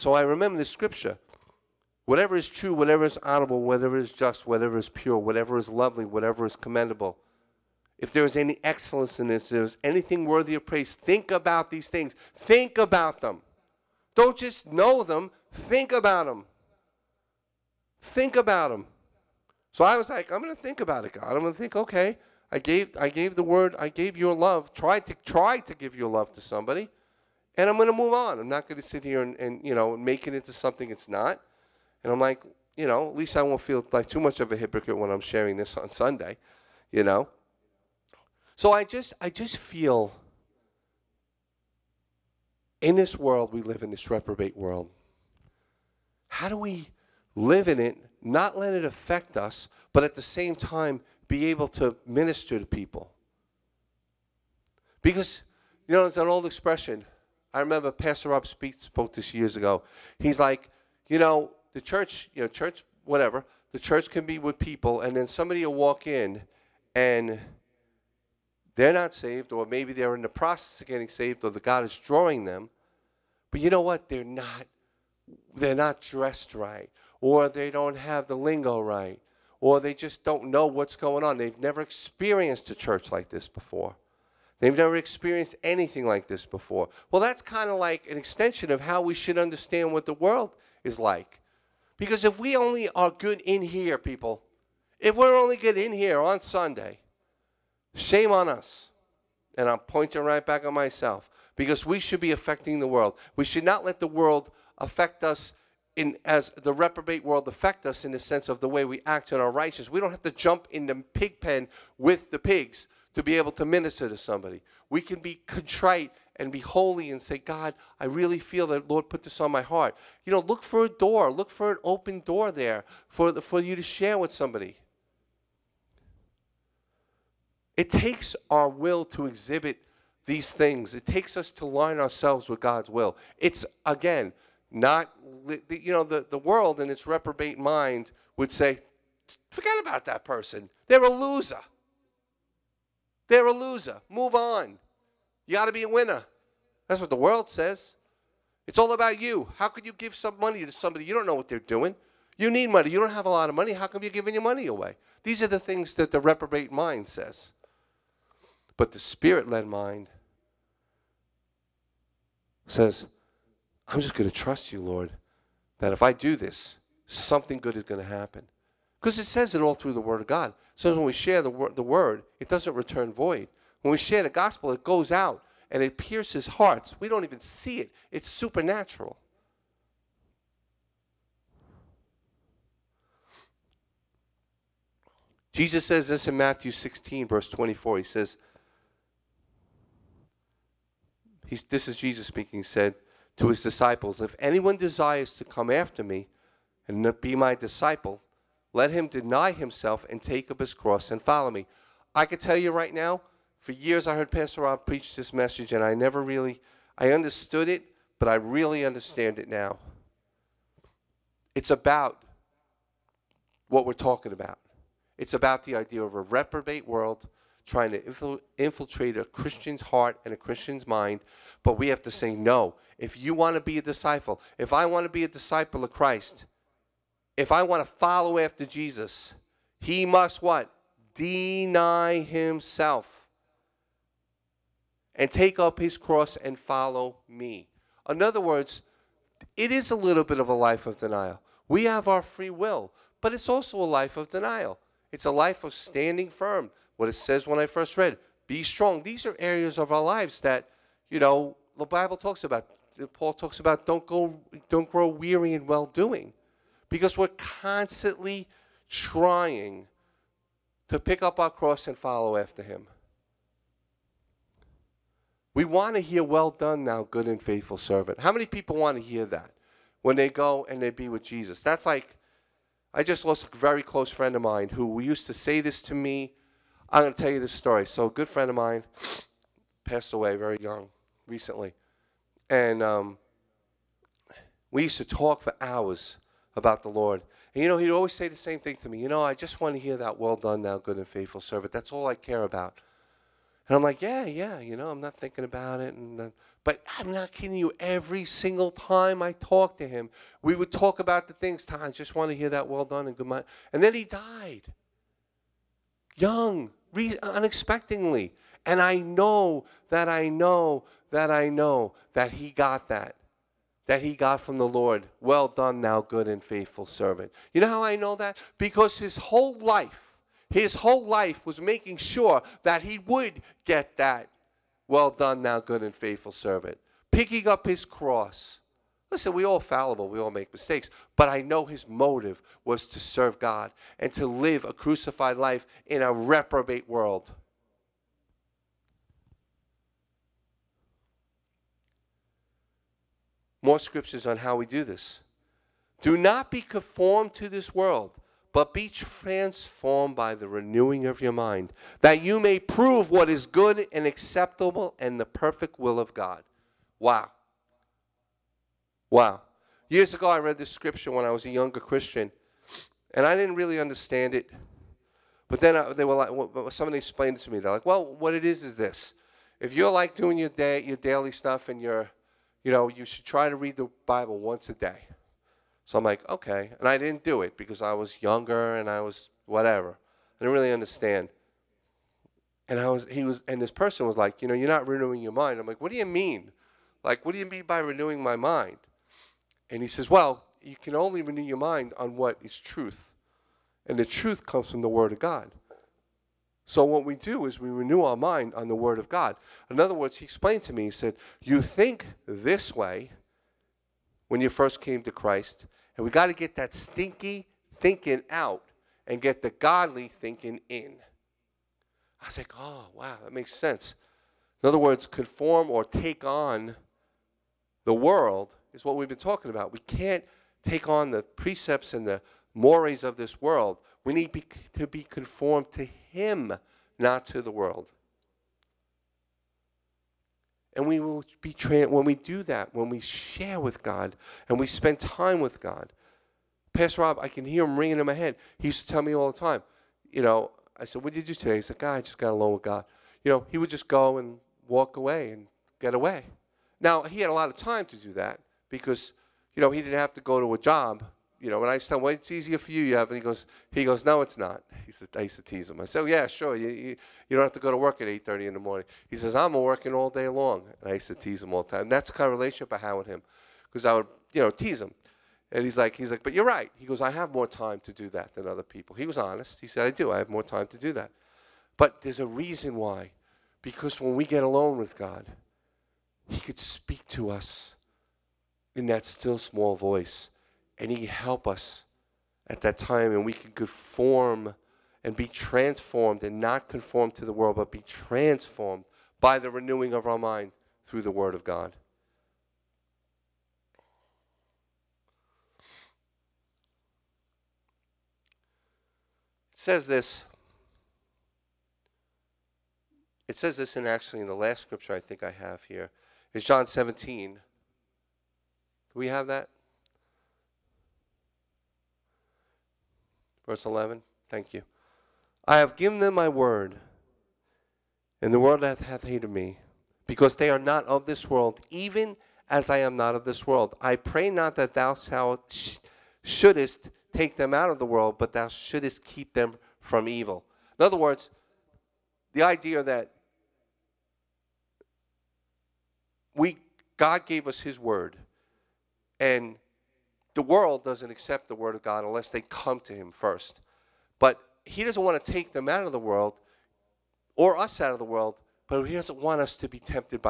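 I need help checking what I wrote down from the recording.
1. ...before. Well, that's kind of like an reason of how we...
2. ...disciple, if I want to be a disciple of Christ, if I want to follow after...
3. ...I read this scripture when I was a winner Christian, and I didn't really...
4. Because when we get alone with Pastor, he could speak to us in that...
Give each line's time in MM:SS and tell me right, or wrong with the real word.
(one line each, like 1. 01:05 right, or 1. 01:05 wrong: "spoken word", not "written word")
1. 01:26 wrong: "extension", not "reason"
2. 03:43 right
3. 06:00 wrong: "younger", not "winner"
4. 07:53 wrong: "God", not "Pastor".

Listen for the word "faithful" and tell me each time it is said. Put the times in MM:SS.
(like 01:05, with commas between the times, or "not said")
04:27, 04:51, 05:16, 05:25.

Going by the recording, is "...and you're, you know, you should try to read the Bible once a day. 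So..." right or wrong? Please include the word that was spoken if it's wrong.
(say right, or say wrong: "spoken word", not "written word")
right.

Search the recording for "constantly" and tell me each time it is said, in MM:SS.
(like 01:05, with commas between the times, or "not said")
04:17.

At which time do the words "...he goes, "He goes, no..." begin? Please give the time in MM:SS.
07:33.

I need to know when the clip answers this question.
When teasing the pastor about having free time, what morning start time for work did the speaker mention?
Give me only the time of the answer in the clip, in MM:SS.
07:38.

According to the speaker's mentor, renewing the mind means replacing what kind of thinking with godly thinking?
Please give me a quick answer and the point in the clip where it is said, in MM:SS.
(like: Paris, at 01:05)
stinky thinking, at 06:46.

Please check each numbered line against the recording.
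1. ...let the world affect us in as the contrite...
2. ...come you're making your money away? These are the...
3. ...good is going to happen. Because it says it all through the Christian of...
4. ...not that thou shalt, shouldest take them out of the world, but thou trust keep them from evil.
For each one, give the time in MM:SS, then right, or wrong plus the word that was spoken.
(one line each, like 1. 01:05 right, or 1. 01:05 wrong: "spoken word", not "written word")
1. 01:43 wrong: "reprobate", not "contrite"
2. 02:33 wrong: "giving", not "making"
3. 02:47 wrong: "Word", not "Christian"
4. 08:44 wrong: "shouldest", not "trust".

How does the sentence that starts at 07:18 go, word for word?
He used to tell me all the time, you know, I said, What did you do today?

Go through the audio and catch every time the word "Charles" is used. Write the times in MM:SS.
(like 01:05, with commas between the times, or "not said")
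not said.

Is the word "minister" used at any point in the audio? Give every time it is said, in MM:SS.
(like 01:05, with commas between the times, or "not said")
00:52, 01:53.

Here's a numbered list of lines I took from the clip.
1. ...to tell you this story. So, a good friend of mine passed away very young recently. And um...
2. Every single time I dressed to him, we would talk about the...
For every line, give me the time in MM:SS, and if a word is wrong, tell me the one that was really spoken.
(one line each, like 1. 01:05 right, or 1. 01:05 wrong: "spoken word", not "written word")
1. 04:37 right
2. 04:57 wrong: "talked", not "dressed".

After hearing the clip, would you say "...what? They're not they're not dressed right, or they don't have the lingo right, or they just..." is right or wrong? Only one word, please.
right.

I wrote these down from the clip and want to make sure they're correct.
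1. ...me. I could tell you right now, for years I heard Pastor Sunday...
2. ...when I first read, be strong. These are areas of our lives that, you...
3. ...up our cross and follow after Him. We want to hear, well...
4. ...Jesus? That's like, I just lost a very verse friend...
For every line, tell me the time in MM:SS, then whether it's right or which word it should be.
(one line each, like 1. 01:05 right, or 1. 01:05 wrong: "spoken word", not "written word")
1. 03:21 wrong: "Rob", not "Sunday"
2. 04:07 right
3. 04:21 right
4. 04:31 wrong: "close", not "verse".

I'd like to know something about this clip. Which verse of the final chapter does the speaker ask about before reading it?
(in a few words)
11.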